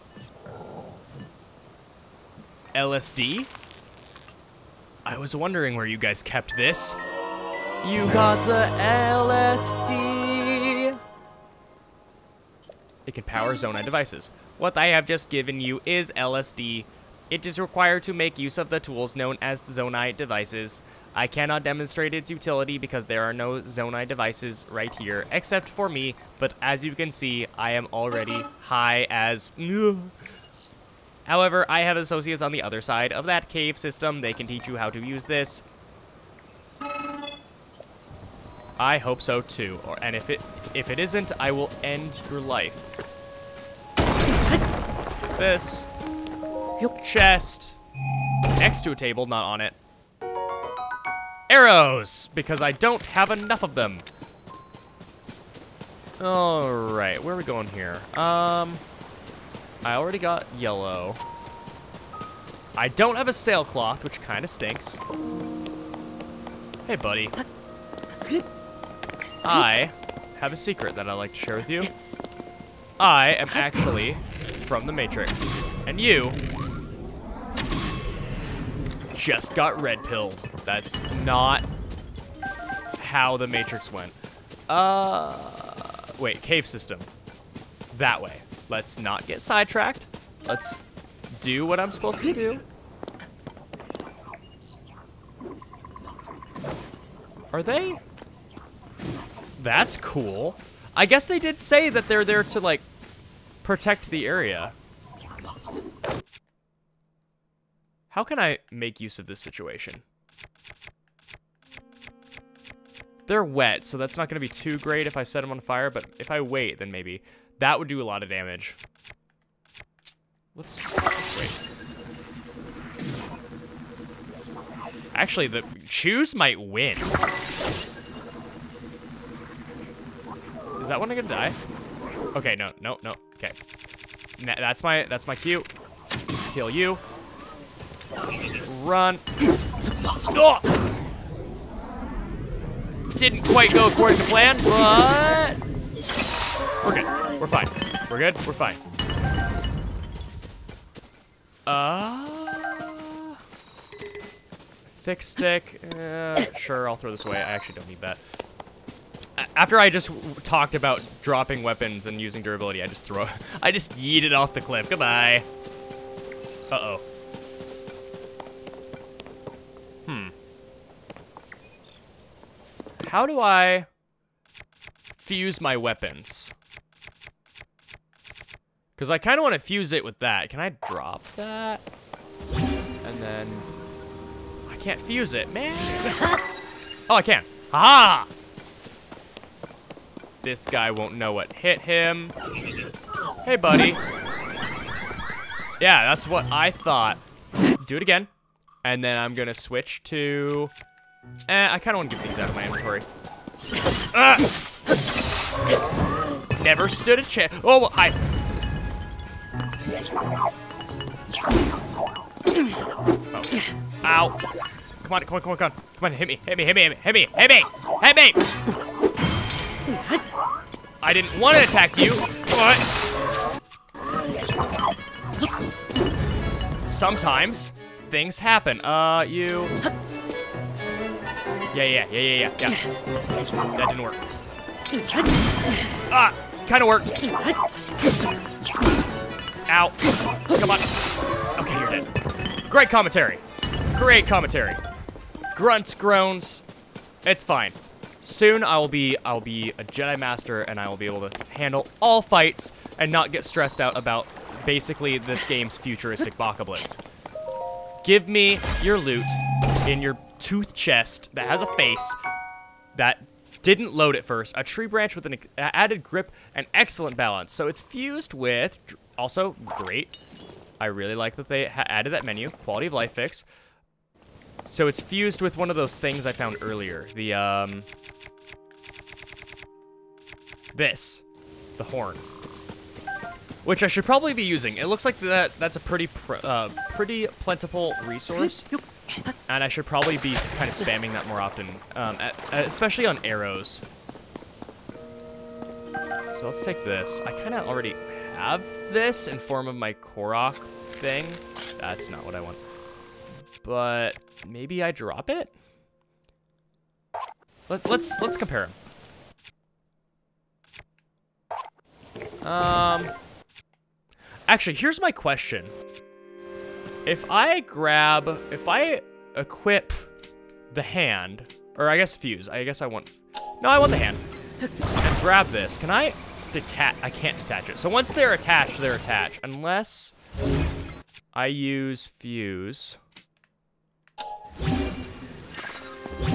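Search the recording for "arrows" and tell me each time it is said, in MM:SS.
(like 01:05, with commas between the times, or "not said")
00:51, 04:53.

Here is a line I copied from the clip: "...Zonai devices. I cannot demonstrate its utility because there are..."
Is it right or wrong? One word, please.
right.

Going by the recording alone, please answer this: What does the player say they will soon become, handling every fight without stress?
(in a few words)
a Jedi Master.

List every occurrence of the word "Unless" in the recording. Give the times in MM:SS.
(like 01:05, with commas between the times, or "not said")
05:29.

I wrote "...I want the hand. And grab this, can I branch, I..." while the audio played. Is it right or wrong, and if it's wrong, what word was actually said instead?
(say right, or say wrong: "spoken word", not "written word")
wrong: "detach", not "branch".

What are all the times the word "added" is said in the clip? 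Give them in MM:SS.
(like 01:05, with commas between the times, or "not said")
04:25, 04:31.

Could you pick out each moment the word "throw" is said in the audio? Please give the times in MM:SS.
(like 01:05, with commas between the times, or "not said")
02:36, 02:43.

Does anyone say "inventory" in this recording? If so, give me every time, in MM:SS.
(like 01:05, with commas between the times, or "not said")
03:22.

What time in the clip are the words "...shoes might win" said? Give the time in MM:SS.
02:05.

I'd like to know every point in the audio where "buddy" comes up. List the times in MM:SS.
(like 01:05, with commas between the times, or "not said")
01:06, 03:13.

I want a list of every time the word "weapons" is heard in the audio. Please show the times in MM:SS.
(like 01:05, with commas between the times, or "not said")
02:41, 02:55.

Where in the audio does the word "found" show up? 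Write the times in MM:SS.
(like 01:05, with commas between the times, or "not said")
04:36.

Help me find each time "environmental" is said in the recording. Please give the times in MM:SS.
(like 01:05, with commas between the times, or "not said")
not said.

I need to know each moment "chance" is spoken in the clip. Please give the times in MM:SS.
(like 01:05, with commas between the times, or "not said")
03:27.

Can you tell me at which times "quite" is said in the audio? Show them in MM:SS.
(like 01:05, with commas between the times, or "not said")
02:23.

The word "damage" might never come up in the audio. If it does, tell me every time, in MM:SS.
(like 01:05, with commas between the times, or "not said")
01:58.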